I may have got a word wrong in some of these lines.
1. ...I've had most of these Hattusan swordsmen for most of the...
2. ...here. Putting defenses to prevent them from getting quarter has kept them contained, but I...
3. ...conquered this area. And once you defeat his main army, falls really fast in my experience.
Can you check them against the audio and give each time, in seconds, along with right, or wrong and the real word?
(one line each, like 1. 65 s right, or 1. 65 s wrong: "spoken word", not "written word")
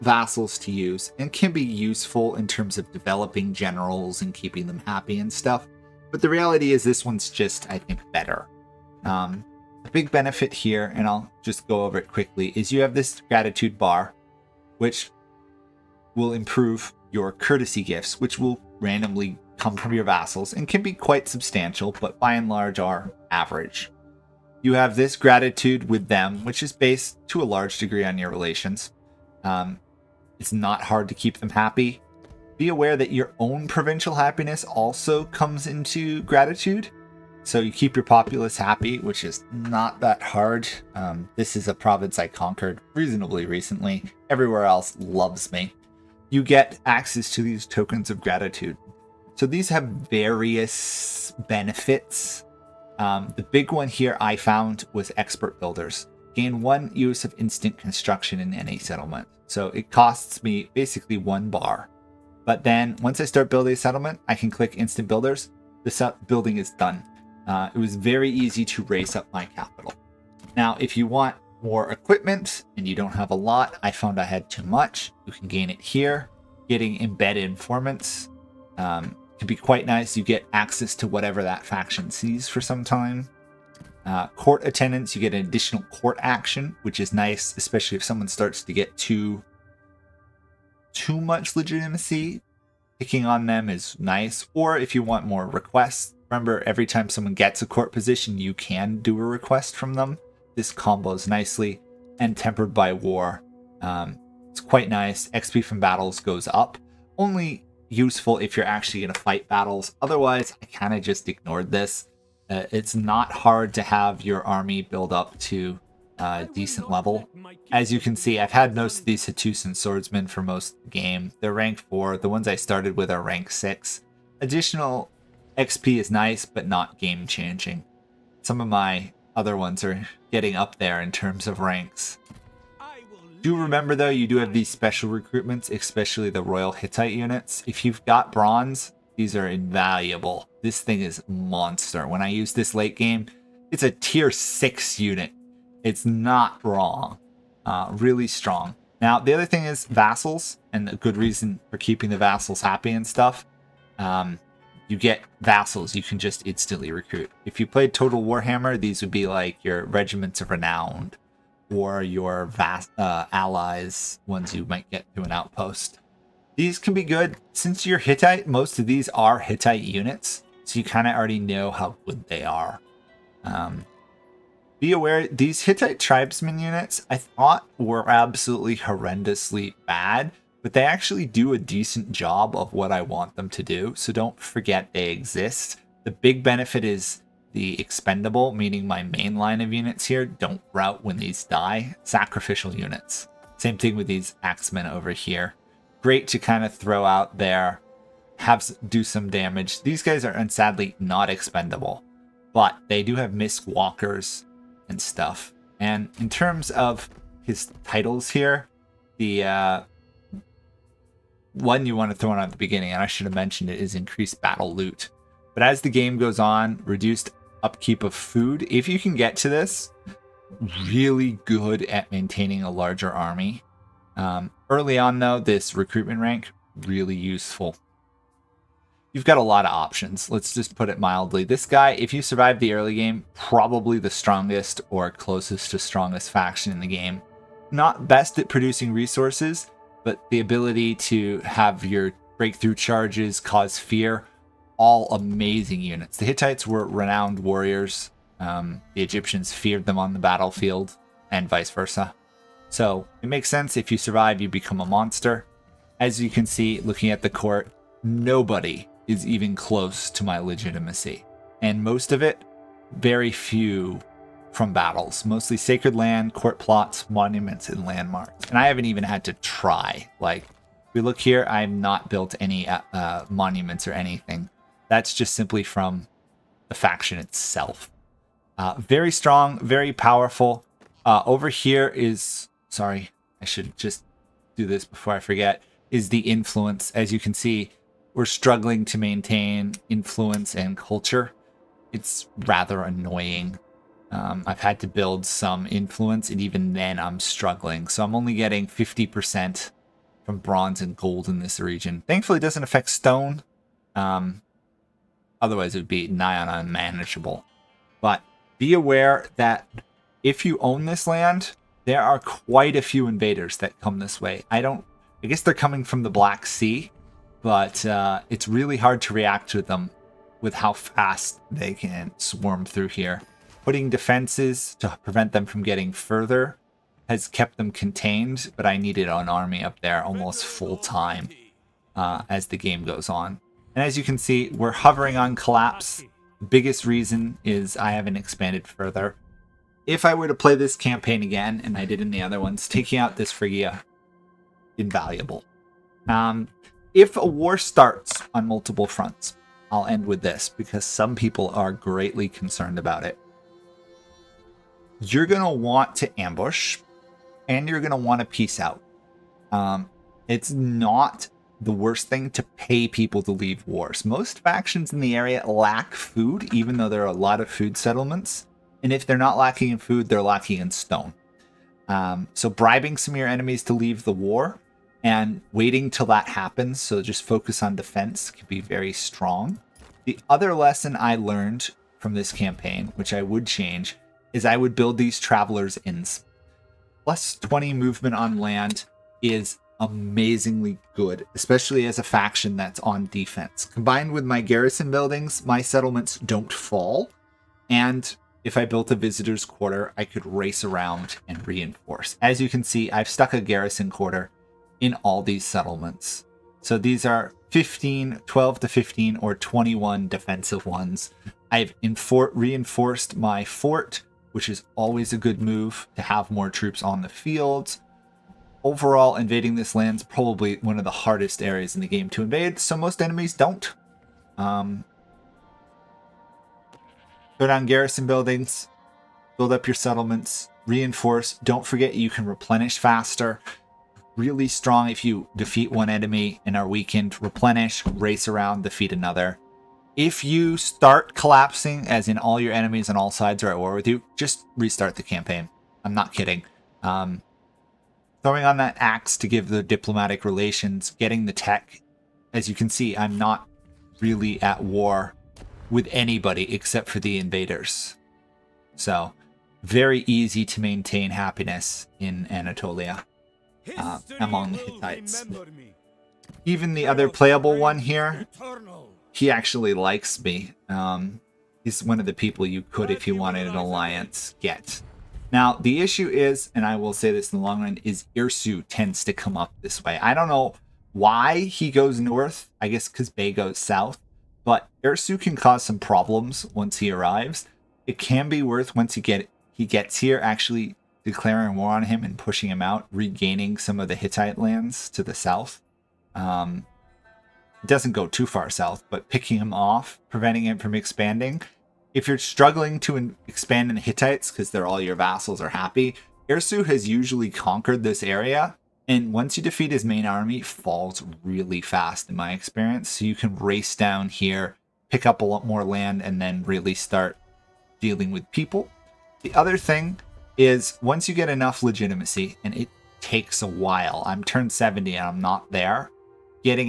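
1. 118 s right
2. 322 s wrong: "further", not "quarter"
3. 507 s right.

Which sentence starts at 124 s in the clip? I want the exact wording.
Additional XP is nice, but not game changing.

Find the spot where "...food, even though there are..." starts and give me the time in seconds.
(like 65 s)
365 s.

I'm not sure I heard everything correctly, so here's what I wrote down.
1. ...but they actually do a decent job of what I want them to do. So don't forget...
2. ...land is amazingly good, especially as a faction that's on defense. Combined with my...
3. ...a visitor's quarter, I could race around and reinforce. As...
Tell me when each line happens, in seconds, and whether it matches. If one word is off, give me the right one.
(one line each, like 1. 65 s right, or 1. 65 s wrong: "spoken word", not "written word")
1. 180 s right
2. 388 s right
3. 398 s right.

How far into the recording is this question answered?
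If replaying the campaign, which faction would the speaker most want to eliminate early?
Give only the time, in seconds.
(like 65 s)
343 s.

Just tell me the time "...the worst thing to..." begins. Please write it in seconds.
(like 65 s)
361 s.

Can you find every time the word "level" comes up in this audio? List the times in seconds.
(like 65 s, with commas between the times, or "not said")
116 s.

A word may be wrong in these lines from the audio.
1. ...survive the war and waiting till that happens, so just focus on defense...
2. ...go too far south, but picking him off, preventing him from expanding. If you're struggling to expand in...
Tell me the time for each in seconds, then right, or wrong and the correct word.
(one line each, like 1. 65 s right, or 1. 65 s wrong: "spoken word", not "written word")
1. 373 s wrong: "leave", not "survive"
2. 497 s right.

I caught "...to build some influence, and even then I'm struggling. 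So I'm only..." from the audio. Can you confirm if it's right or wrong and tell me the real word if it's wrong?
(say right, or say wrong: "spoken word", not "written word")
right.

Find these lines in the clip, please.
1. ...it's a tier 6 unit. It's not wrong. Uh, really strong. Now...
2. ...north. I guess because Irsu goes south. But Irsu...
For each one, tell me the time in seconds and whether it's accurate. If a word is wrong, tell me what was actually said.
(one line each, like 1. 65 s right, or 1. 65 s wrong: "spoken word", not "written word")
1. 143 s right
2. 482 s wrong: "Bay", not "Irsu".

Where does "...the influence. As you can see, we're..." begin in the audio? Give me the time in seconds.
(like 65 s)
286 s.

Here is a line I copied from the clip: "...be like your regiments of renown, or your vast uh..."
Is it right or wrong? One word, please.
right.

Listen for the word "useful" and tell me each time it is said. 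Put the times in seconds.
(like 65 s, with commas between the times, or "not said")
1 s, 107 s, 227 s.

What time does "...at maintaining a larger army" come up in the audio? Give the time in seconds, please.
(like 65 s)
221 s.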